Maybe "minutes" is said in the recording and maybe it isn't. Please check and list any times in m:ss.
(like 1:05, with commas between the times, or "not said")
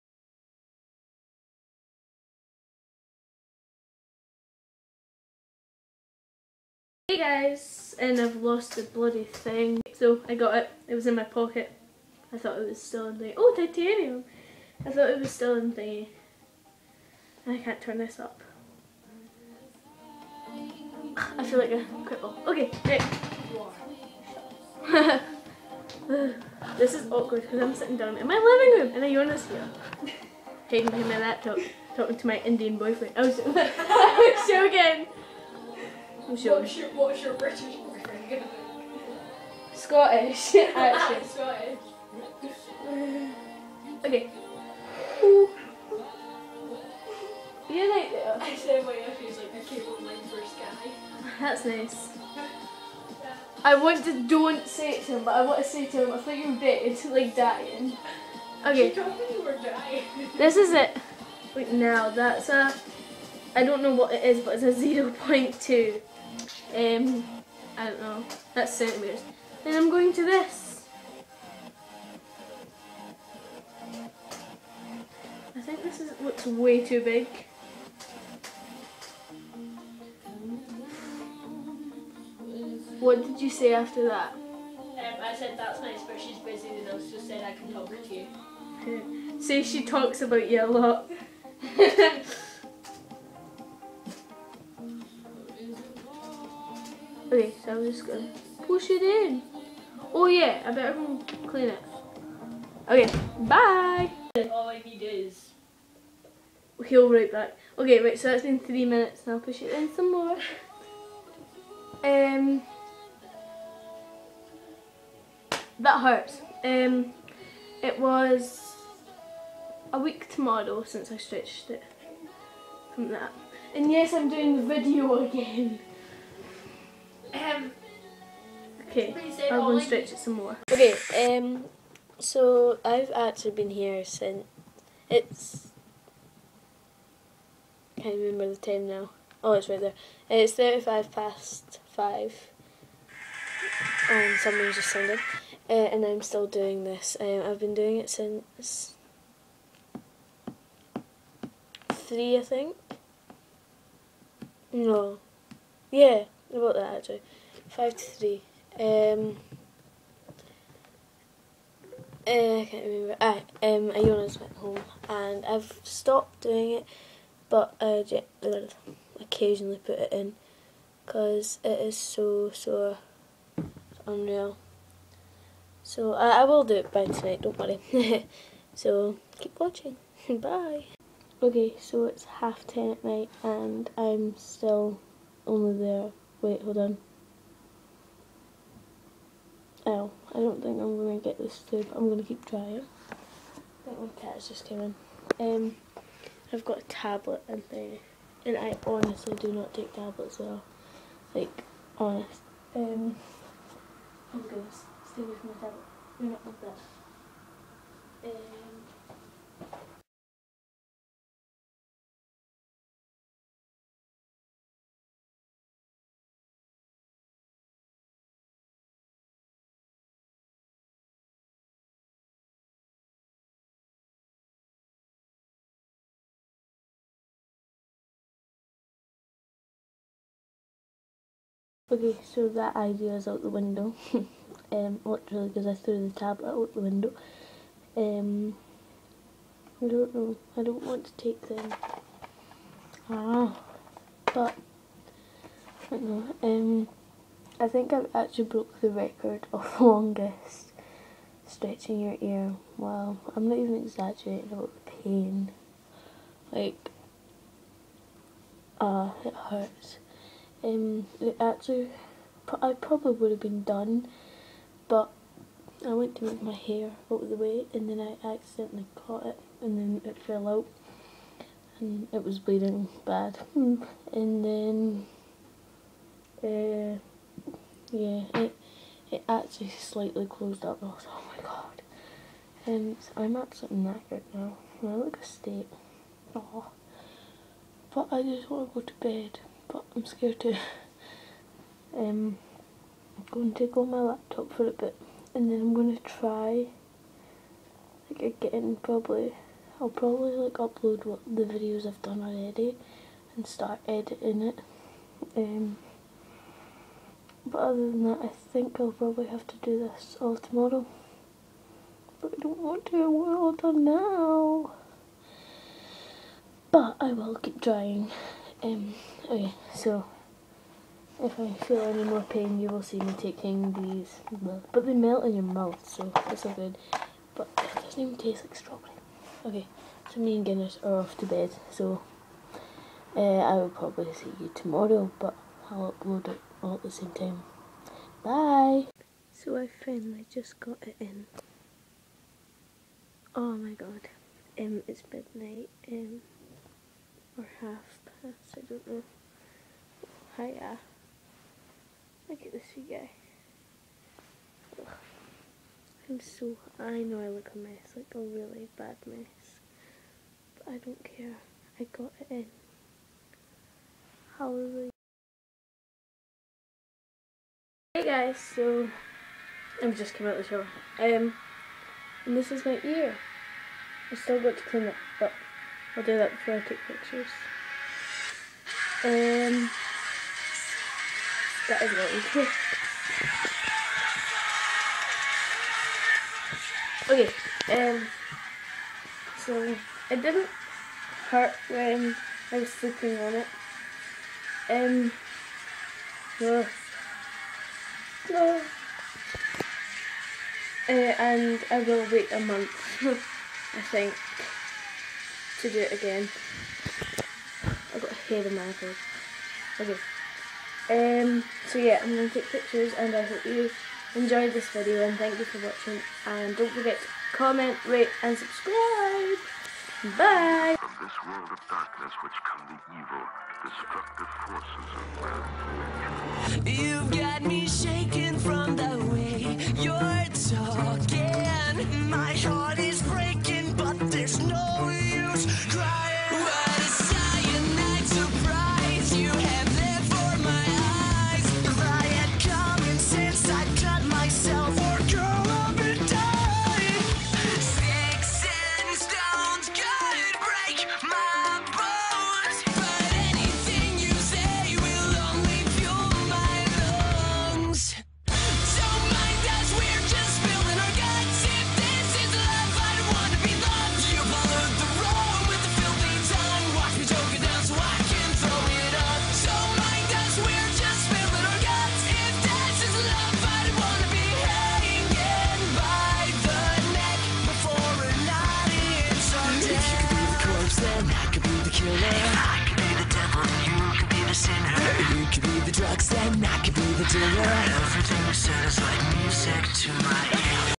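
1:48.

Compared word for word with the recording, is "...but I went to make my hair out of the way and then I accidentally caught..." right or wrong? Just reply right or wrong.
right.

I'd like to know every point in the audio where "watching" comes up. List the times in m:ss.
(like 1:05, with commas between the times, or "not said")
2:59, 6:55.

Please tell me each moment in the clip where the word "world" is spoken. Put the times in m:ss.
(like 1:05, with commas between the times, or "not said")
7:01.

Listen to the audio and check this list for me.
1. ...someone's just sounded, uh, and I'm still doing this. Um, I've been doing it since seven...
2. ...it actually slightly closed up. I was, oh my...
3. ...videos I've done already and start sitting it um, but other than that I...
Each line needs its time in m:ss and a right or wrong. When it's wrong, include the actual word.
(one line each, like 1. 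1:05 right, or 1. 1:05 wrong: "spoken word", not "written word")
1. 2:24 wrong: "three", not "seven"
2. 4:39 right
3. 5:01 wrong: "editing", not "sitting".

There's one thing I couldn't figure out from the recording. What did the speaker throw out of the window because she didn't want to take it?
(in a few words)
The tablet.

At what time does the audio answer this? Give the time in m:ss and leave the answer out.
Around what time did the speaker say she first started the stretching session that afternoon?
2:37.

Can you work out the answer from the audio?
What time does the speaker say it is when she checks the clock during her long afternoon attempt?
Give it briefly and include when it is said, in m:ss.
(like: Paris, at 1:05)
5:35, at 2:20.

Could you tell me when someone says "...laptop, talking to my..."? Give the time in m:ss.
0:31.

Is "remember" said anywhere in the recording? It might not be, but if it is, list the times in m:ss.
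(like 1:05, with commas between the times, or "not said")
2:18, 2:42.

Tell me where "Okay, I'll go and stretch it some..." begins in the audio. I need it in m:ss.
2:08.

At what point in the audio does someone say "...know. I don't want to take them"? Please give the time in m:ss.
4:00.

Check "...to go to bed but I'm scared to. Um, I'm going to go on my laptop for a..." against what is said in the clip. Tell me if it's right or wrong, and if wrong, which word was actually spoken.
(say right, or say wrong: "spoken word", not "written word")
right.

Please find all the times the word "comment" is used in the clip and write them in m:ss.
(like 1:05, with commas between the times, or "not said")
6:57.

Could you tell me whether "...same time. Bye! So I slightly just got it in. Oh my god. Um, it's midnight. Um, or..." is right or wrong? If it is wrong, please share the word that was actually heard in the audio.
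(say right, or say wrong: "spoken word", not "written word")
wrong: "finally", not "slightly".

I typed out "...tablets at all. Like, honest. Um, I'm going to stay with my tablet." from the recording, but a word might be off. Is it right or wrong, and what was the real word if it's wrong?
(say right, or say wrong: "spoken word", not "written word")
right.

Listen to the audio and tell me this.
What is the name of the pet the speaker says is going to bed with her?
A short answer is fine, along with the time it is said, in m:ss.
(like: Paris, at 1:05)
Guinness, at 5:30.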